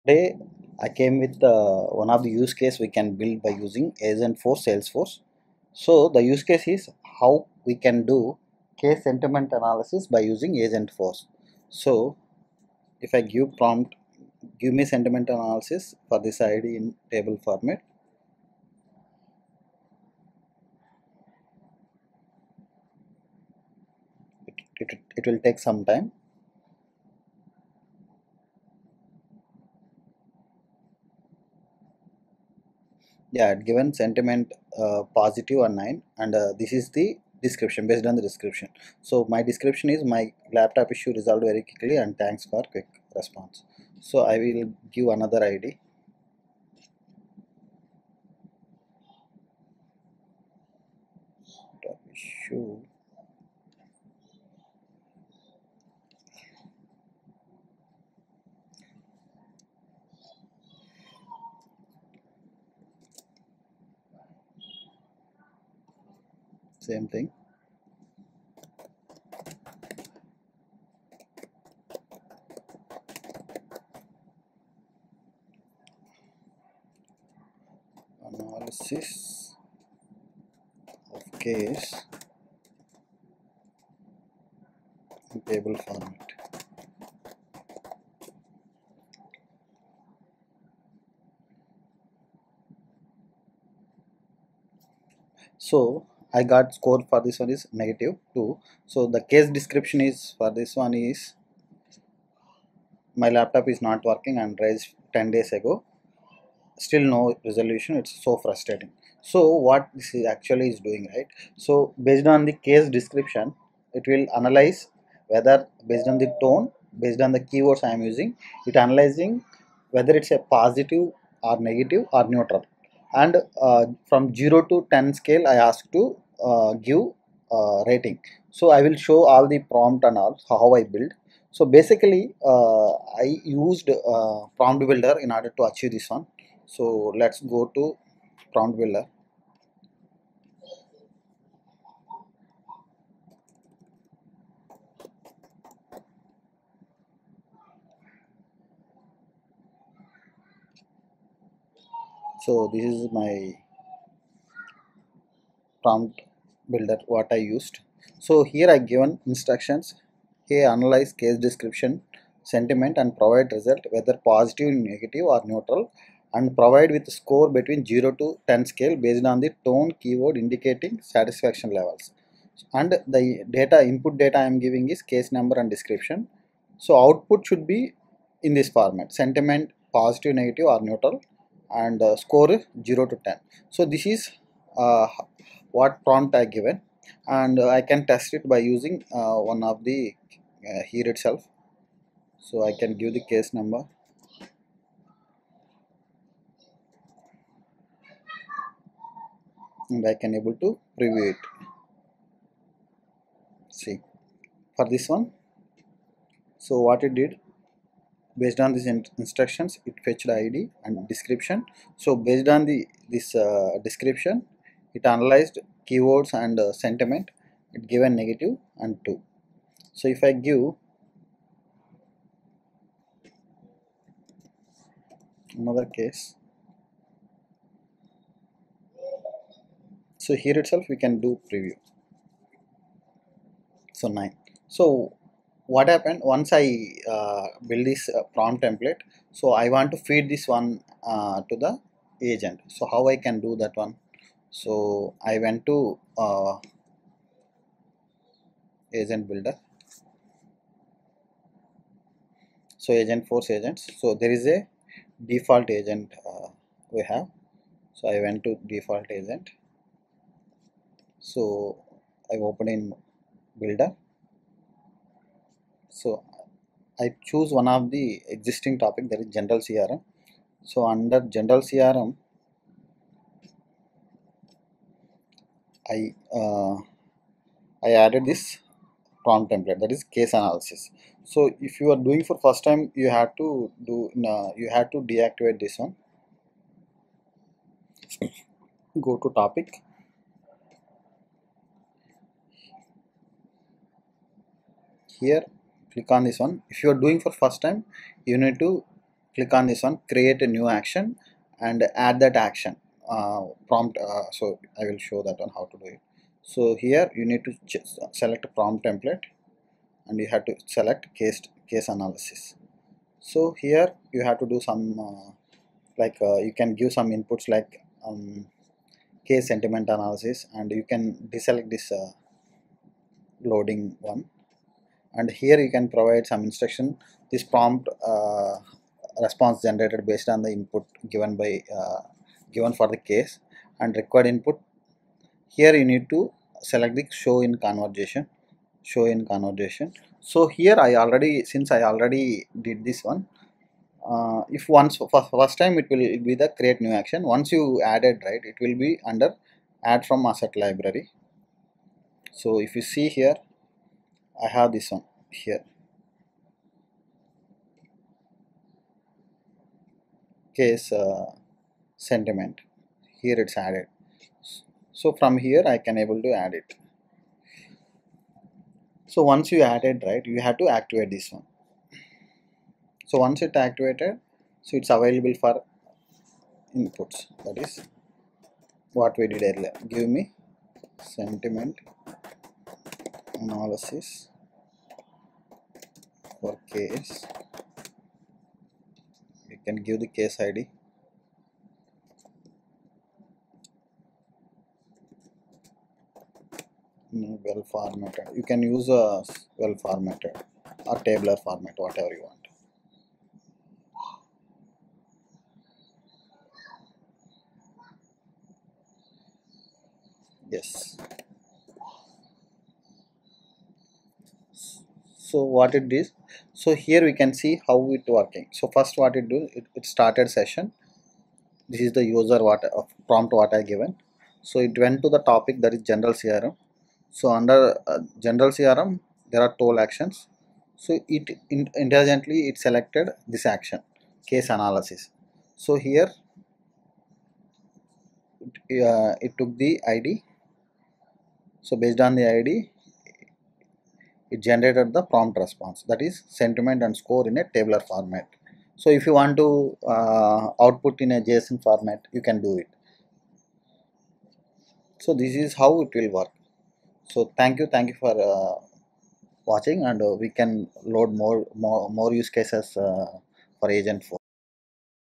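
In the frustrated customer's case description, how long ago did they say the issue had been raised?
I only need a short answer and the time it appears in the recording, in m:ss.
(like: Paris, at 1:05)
10 days ago, at 1:44.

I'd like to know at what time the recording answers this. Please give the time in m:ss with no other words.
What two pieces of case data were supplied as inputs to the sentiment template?
2:55.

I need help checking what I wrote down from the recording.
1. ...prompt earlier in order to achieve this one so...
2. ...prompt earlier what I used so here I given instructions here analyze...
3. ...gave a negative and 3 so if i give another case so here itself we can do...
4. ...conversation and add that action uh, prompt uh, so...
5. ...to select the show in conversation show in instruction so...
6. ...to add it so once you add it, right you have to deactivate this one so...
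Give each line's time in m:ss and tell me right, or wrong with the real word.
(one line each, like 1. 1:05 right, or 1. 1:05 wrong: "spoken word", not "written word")
1. 2:14 wrong: "builder", not "earlier"
2. 2:35 wrong: "builder", not "earlier"
3. 3:37 wrong: "2", not "3"
4. 5:00 wrong: "action", not "conversation"
5. 5:36 wrong: "conversation", not "instruction"
6. 6:06 wrong: "activate", not "deactivate".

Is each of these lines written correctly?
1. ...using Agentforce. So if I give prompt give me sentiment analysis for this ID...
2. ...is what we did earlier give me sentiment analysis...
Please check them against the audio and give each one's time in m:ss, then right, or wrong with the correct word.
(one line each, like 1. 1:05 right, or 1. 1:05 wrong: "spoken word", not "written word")
1. 0:10 right
2. 6:17 right.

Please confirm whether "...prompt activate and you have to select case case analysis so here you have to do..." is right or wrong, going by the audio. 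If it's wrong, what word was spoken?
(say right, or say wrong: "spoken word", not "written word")
wrong: "template", not "activate".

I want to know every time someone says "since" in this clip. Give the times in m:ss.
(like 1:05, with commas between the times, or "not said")
5:41.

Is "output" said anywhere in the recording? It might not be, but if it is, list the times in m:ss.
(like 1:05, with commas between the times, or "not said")
2:57, 7:30.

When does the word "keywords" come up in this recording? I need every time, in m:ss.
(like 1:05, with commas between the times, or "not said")
1:57, 2:50, 3:35.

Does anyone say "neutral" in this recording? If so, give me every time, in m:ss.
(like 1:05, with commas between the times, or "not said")
2:02, 2:45, 3:00.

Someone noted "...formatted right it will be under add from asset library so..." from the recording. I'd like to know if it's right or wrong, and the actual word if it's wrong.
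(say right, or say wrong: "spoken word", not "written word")
wrong: "added", not "formatted".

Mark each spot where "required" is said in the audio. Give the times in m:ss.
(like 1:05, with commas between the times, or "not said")
5:33.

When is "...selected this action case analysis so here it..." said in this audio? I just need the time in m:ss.
7:12.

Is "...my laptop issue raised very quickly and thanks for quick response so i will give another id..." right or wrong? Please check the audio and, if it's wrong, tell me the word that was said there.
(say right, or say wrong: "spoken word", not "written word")
wrong: "resolved", not "raised".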